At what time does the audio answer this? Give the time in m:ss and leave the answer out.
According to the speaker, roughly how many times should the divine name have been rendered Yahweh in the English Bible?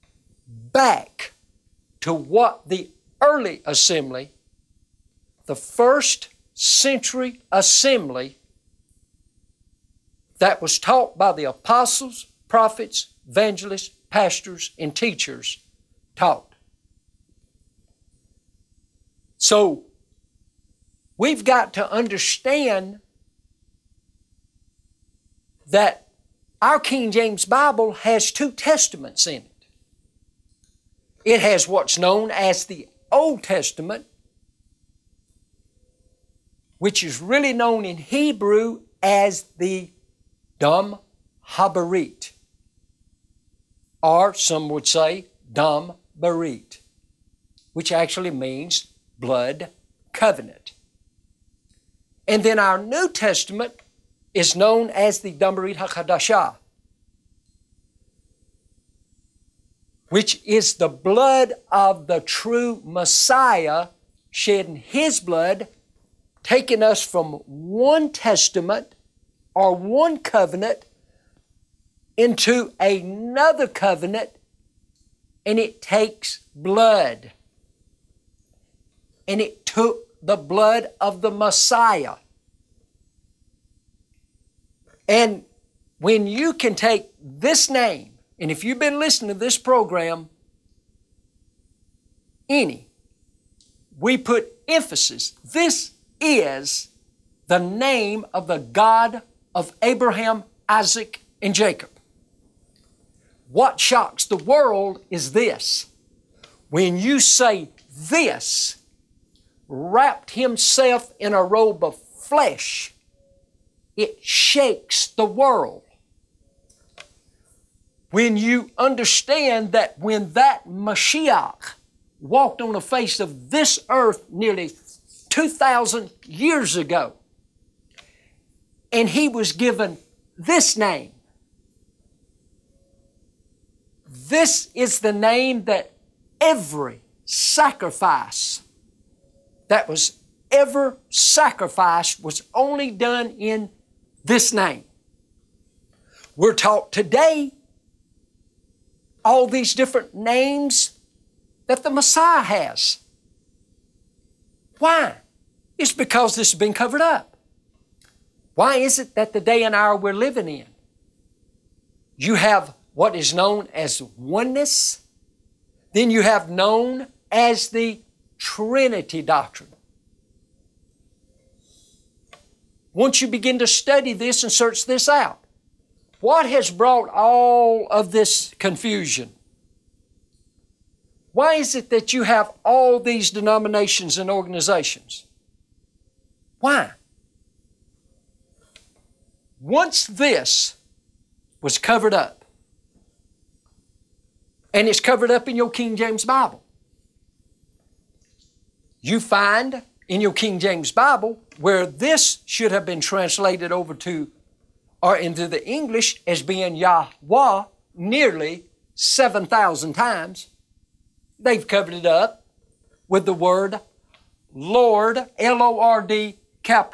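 3:28.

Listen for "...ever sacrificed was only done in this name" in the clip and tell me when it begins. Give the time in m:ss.
2:20.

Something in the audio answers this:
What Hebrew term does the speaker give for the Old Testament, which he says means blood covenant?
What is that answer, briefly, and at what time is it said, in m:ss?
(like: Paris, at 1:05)
Dam Habarit, at 0:40.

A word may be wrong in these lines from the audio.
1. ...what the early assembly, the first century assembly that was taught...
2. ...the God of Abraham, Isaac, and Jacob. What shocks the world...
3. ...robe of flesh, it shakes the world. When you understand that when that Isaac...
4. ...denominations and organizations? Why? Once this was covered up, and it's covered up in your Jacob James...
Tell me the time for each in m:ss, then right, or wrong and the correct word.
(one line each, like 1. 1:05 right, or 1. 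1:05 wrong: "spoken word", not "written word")
1. 0:02 right
2. 1:38 right
3. 1:51 wrong: "Messiah", not "Isaac"
4. 3:03 wrong: "King", not "Jacob".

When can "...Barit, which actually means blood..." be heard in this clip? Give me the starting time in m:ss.
0:46.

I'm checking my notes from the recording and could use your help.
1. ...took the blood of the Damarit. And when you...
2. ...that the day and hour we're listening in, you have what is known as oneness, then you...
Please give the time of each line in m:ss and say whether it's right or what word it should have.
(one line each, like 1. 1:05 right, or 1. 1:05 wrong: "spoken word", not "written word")
1. 1:19 wrong: "Messiah", not "Damarit"
2. 2:39 wrong: "living", not "listening".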